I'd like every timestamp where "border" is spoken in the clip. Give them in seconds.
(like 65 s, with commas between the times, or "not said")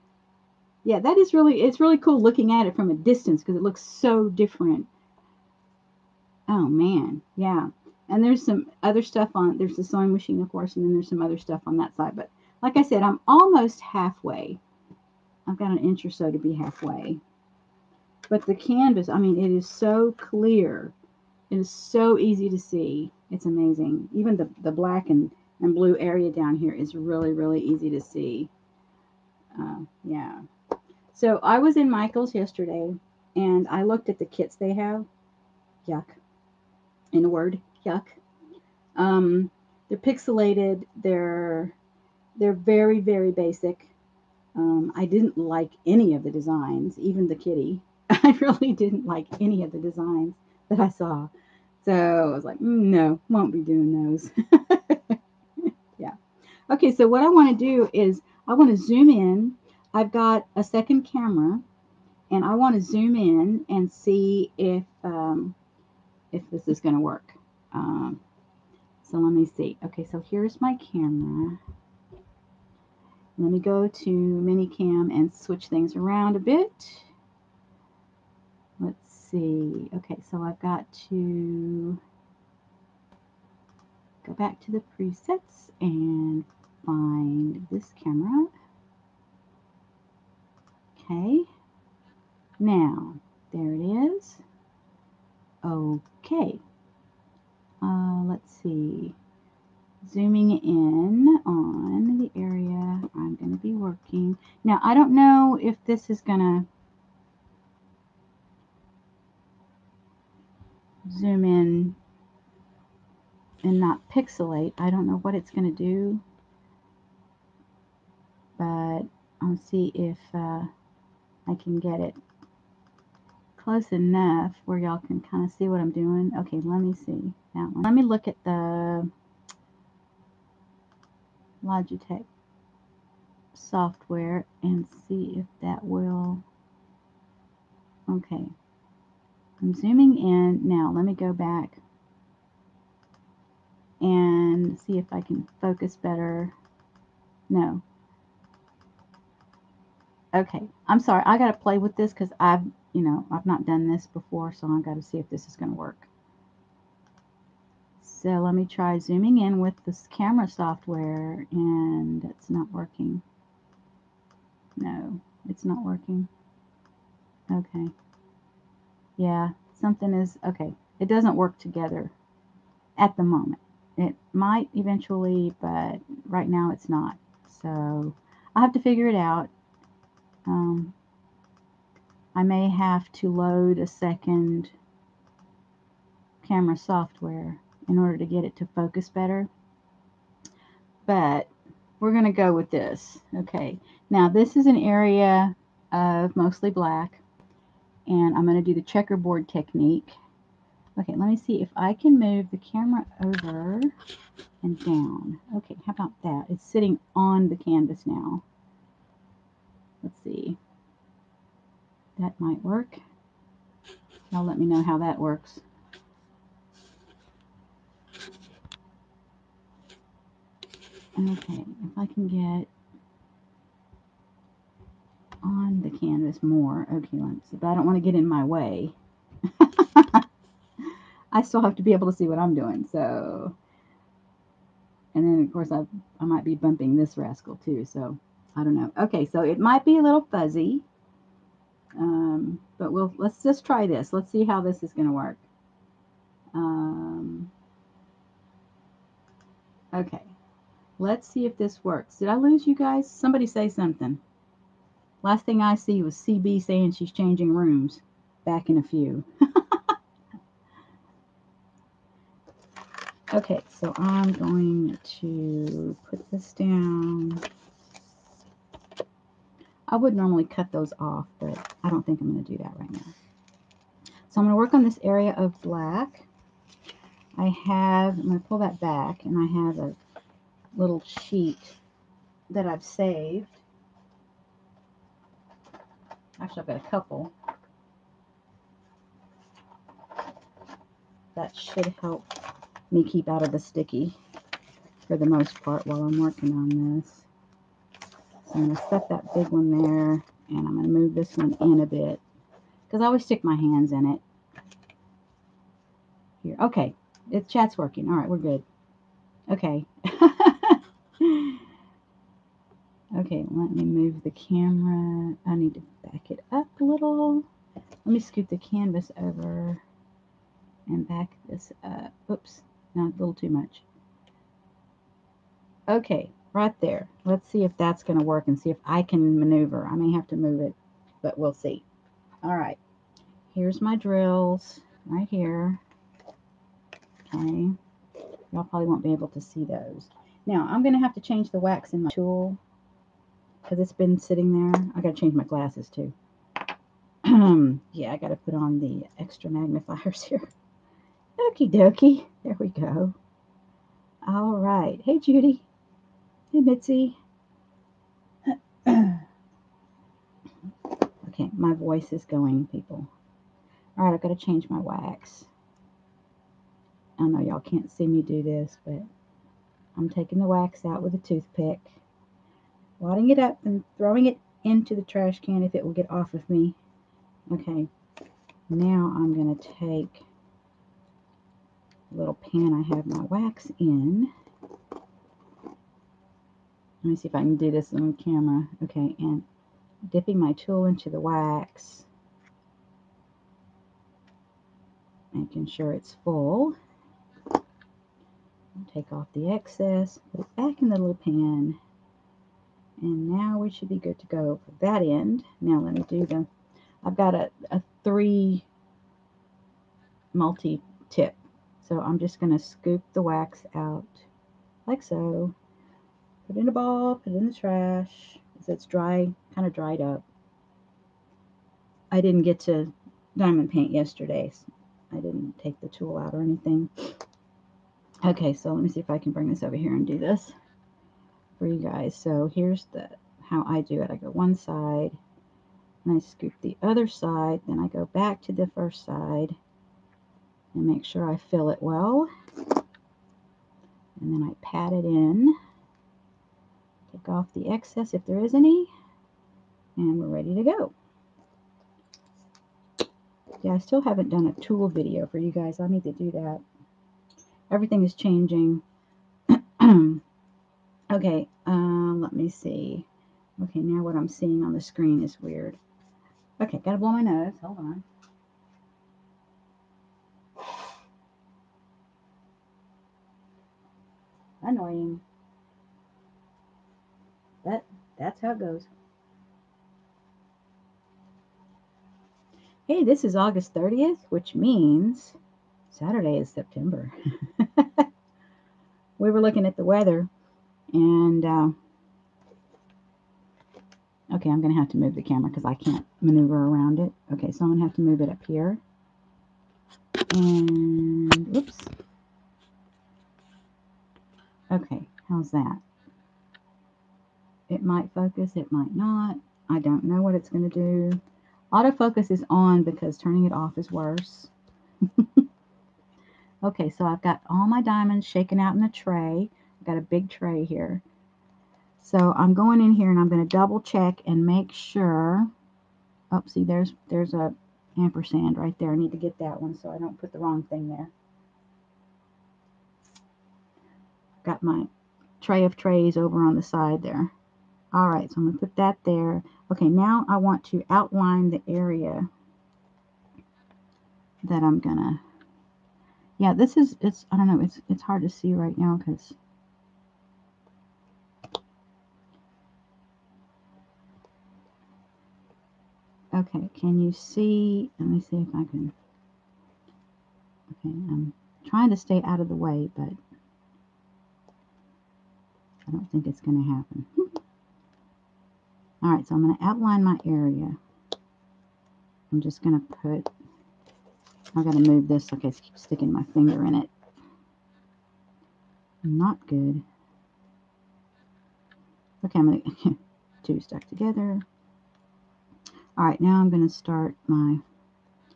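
not said.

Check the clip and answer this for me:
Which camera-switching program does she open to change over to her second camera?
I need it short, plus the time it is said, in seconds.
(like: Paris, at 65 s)
ManyCam, at 74 s.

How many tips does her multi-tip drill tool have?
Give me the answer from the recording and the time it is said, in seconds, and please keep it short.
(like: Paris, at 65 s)
3, at 408 s.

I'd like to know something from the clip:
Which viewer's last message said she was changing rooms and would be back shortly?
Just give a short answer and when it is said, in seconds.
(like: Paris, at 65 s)
CB, at 256 s.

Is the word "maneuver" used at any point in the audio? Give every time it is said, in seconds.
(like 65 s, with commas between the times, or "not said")
329 s, 496 s.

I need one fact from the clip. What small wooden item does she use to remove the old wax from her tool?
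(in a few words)
toothpick.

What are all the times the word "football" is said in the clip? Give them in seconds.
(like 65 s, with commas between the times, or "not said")
not said.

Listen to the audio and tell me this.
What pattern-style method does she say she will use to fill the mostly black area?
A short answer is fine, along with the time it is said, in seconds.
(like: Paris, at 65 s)
checkerboard technique, at 198 s.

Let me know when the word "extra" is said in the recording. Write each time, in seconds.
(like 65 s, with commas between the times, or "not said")
349 s.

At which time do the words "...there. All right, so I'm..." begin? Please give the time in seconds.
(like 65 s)
537 s.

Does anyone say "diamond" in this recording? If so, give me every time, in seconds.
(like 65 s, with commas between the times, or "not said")
423 s, 517 s.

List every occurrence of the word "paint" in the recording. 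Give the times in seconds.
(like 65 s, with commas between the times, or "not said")
423 s.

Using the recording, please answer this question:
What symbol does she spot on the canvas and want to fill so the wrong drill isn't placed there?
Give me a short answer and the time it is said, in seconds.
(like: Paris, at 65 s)
ampersand, at 527 s.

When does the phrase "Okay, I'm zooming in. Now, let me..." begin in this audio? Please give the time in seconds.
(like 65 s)
138 s.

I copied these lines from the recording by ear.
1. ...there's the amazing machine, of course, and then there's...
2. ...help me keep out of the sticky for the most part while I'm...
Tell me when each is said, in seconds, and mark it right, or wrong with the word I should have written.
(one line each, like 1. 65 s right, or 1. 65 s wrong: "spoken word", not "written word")
1. 9 s wrong: "sewing", not "amazing"
2. 292 s right.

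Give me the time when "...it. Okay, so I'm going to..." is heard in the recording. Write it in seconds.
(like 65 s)
496 s.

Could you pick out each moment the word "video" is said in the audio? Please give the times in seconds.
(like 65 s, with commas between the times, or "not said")
454 s.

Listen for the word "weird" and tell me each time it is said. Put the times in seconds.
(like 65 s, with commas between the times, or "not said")
465 s.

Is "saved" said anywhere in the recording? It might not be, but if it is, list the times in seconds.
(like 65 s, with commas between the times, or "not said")
282 s.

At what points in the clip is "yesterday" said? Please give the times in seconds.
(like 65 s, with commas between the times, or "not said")
32 s, 423 s.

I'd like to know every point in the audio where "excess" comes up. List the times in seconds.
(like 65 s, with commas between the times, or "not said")
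399 s, 447 s.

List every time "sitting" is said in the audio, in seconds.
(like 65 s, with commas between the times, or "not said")
206 s, 344 s.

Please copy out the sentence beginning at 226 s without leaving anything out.
Okay, but I don't want to get in my way.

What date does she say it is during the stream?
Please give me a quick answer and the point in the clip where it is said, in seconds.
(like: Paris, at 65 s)
August 30th, at 483 s.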